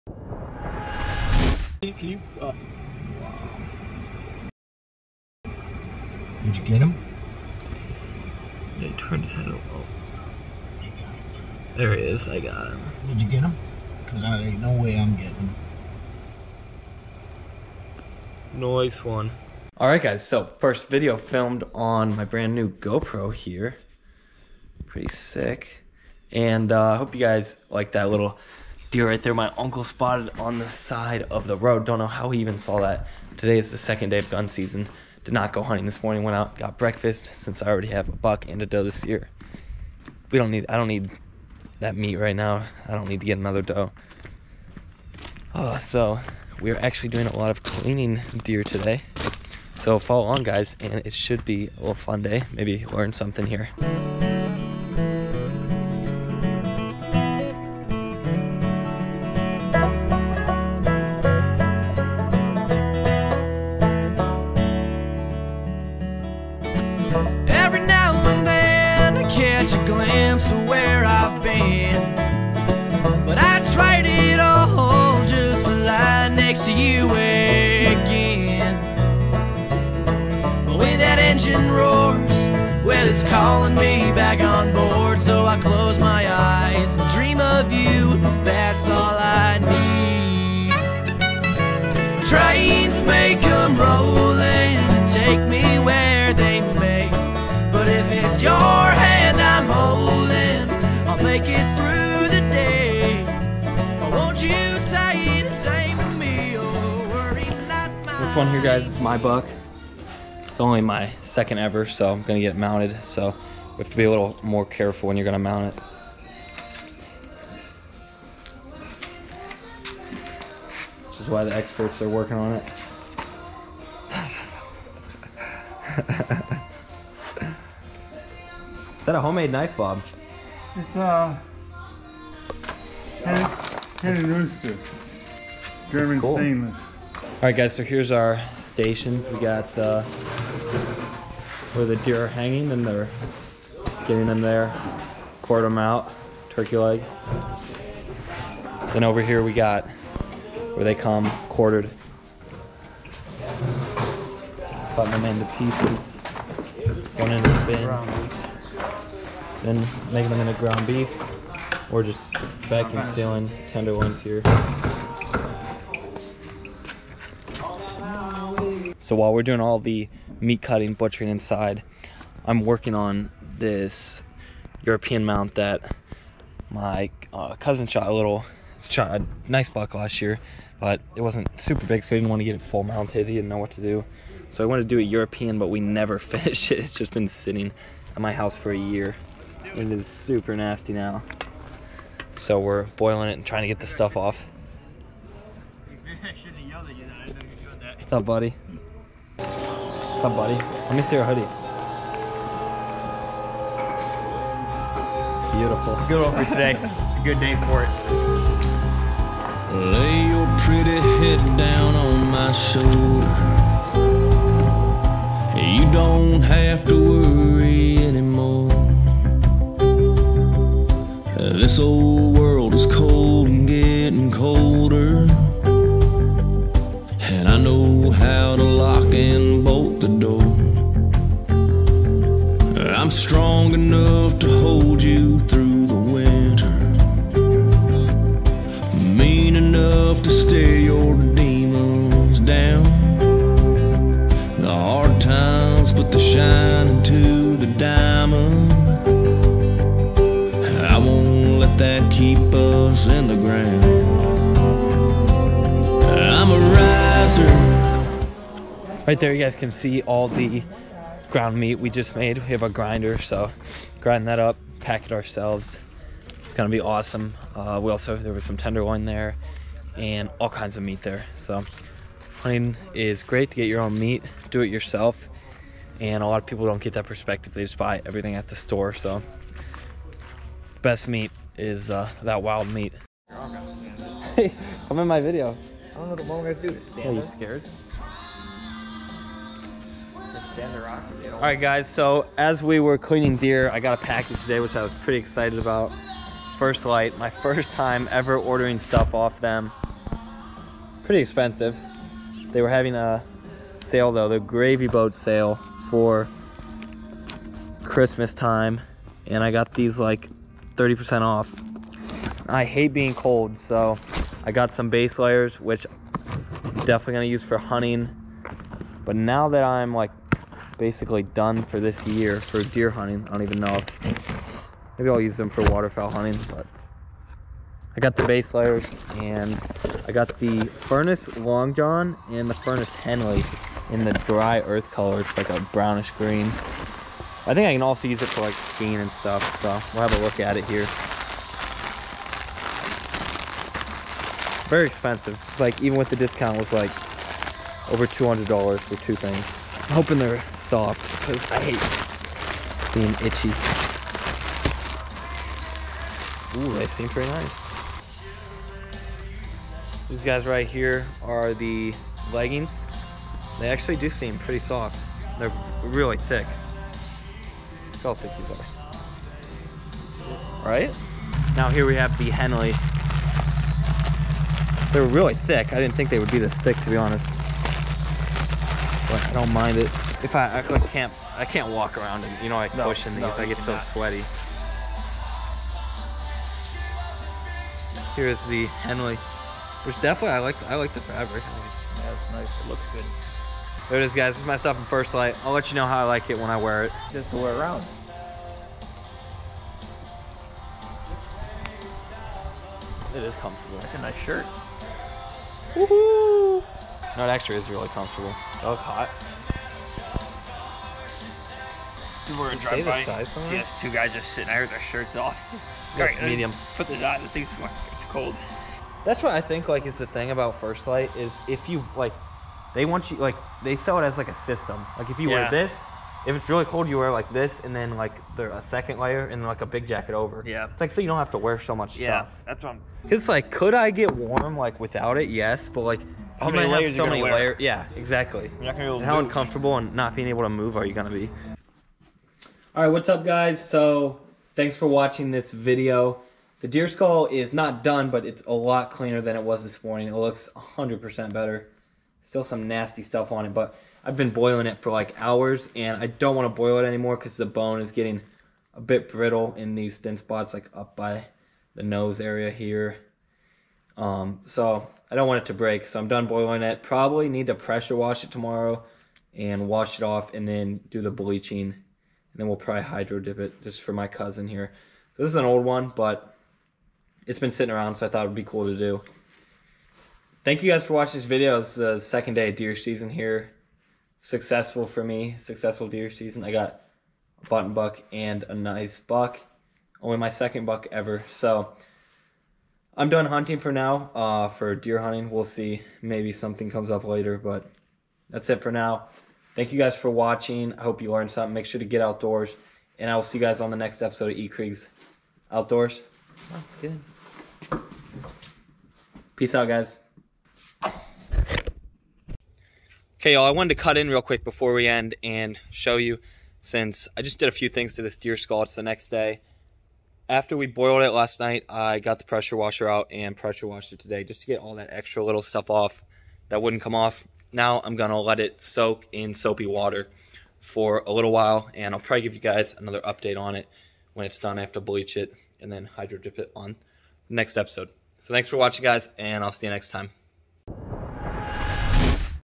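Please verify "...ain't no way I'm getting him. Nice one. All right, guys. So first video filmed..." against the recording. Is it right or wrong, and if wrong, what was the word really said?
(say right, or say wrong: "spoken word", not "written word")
right.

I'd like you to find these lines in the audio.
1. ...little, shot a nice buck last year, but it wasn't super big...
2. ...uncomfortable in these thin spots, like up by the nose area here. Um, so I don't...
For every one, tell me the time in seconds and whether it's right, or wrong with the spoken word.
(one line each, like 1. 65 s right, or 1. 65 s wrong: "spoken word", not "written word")
1. 178 s right
2. 459 s wrong: "brittle", not "uncomfortable".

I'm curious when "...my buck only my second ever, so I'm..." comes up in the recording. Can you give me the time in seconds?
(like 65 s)
109 s.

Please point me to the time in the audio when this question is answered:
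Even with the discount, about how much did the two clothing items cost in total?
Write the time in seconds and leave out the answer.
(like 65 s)
347 s.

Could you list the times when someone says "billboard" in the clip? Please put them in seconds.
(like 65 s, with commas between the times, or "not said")
not said.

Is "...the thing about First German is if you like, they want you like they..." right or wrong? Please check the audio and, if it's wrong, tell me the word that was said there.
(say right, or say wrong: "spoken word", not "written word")
wrong: "Lite", not "German".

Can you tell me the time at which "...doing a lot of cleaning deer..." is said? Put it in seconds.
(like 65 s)
47 s.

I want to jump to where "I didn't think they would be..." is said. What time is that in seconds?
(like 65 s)
375 s.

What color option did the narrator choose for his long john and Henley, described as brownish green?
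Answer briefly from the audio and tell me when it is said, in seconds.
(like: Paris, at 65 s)
dry earth, at 334 s.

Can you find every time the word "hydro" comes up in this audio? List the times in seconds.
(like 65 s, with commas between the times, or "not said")
472 s, 535 s.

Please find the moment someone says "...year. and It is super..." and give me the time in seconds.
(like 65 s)
188 s.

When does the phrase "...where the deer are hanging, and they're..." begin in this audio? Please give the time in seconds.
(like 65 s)
141 s.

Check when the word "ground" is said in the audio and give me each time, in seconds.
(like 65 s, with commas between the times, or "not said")
160 s, 261 s.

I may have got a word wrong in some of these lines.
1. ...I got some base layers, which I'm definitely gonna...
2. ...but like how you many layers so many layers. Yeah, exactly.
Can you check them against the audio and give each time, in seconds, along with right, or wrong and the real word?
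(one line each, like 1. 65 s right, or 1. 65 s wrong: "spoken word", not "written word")
1. 314 s right
2. 435 s right.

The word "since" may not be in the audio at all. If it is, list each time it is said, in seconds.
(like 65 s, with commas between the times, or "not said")
37 s, 516 s.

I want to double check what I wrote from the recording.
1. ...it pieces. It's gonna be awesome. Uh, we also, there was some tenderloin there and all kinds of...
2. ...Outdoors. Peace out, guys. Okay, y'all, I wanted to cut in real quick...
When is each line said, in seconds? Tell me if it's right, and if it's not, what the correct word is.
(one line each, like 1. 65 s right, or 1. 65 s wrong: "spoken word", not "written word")
1. 265 s wrong: "ourselves", not "pieces"
2. 505 s right.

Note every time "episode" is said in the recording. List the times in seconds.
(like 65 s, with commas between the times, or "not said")
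504 s, 537 s.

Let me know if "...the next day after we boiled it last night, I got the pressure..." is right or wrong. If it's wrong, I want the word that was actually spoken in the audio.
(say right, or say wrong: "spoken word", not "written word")
right.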